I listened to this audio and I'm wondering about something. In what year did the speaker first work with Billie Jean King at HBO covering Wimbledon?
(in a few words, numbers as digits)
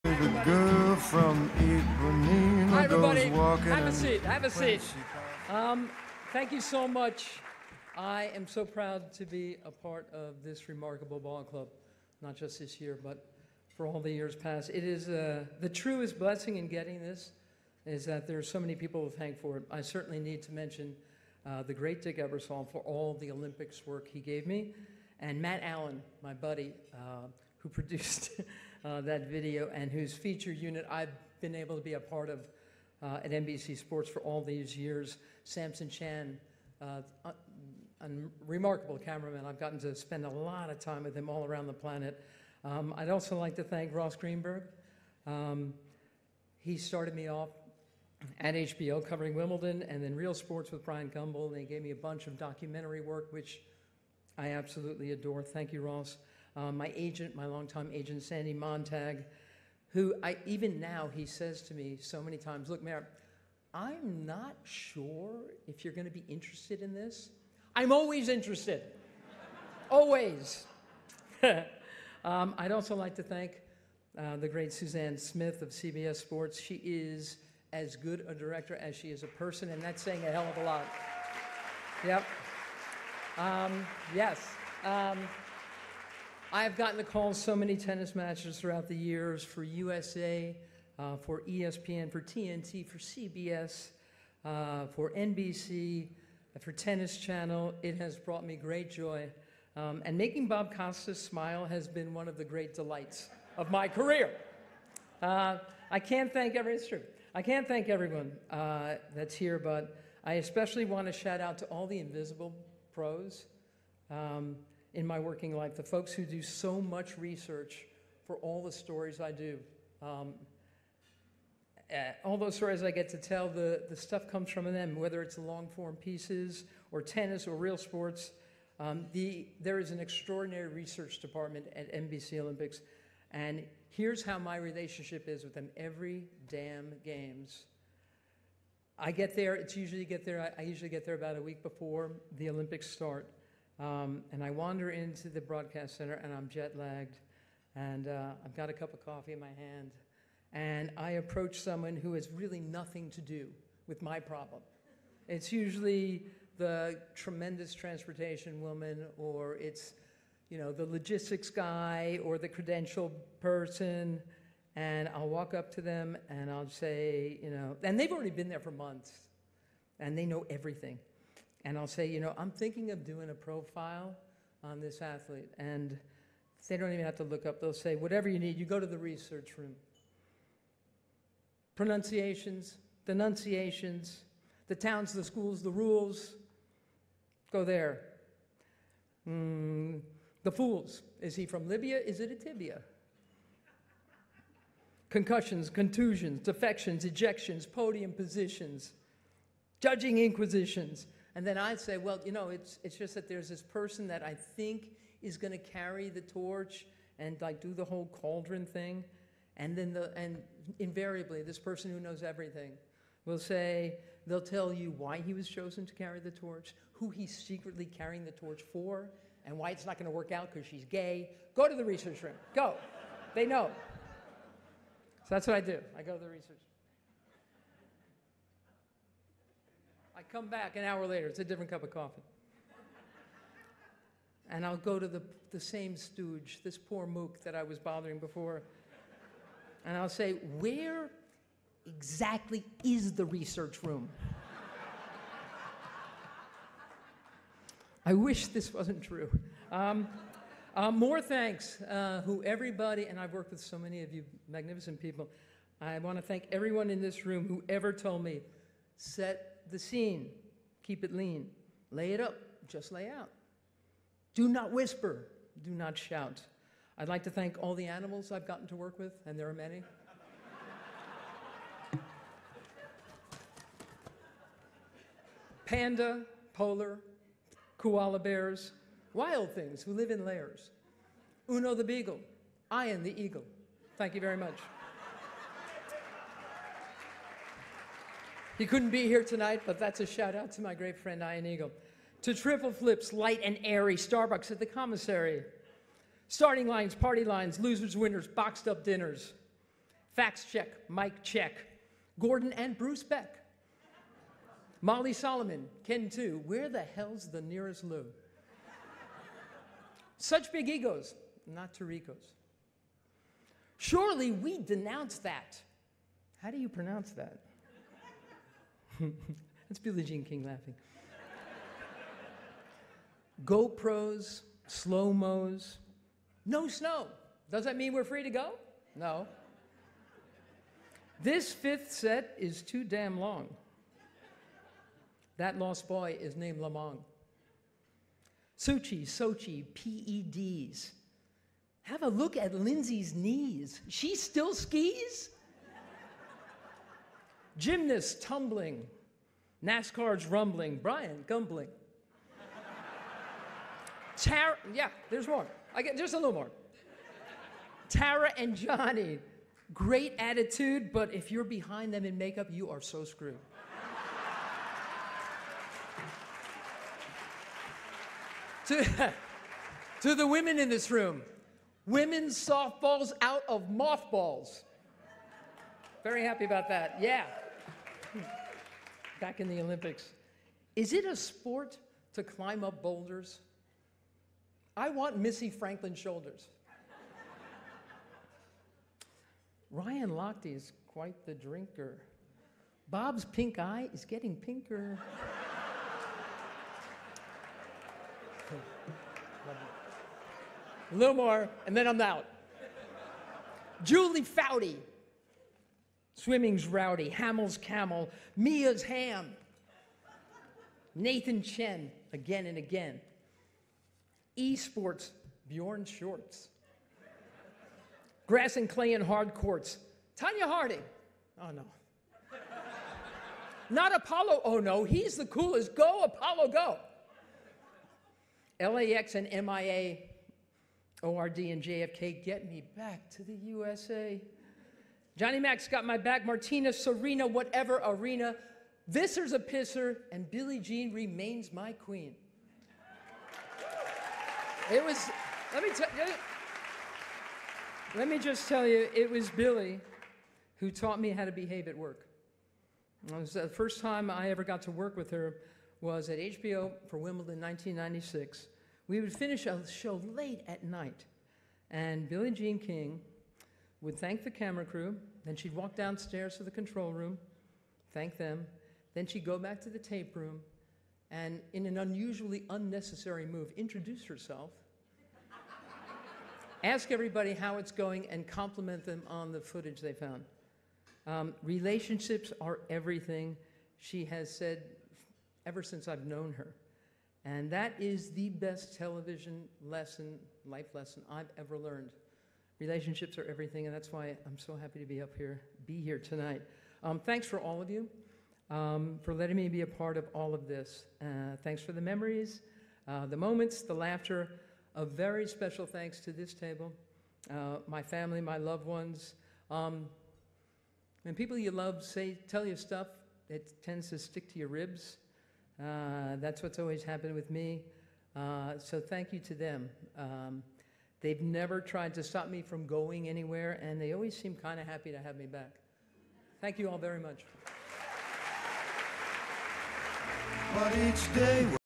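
1996.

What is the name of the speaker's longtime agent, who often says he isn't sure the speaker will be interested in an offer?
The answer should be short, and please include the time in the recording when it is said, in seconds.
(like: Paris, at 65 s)
Sandy Montag, at 58 s.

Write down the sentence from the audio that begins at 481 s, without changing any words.
Um, relationships are everything, she has said ever since I've known her.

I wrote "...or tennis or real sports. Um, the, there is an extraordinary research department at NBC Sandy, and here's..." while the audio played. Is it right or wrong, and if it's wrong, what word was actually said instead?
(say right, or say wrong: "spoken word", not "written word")
wrong: "Olympics", not "Sandy".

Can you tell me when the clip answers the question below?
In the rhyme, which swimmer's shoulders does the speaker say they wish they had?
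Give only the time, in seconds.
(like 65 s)
385 s.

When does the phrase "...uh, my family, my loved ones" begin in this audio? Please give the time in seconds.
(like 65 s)
507 s.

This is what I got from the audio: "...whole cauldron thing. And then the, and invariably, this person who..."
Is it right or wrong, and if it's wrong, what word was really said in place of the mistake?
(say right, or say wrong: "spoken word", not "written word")
right.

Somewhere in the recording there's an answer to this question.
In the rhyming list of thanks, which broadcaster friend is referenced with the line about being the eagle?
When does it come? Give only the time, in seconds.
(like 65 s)
291 s.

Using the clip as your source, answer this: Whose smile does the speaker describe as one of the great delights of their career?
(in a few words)
Bob Costas.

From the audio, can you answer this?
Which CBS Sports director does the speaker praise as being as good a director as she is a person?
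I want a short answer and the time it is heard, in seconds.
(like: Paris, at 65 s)
Suzanne Smith, at 74 s.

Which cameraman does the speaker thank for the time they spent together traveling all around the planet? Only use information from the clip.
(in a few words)
Samson Chan.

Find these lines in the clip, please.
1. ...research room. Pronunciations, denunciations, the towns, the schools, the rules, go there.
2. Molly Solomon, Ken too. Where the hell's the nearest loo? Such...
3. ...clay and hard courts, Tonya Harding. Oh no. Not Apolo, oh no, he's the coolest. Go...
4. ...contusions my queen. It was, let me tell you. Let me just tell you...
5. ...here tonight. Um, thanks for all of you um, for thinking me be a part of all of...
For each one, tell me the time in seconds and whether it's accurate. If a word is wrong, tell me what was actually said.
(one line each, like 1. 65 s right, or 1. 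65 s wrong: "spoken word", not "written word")
1. 178 s right
2. 304 s right
3. 418 s right
4. 440 s wrong: "remains", not "contusions"
5. 495 s wrong: "letting", not "thinking".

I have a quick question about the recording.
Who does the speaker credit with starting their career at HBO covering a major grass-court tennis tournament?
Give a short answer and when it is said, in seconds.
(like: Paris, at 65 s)
Ross Greenberg, at 43 s.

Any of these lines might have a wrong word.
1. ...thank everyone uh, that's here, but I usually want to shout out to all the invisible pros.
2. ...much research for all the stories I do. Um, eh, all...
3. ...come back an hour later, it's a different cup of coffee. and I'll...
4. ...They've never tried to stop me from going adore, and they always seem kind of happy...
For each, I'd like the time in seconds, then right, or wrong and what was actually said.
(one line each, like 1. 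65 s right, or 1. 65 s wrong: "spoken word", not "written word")
1. 107 s wrong: "especially", not "usually"
2. 116 s right
3. 230 s right
4. 521 s wrong: "anywhere", not "adore".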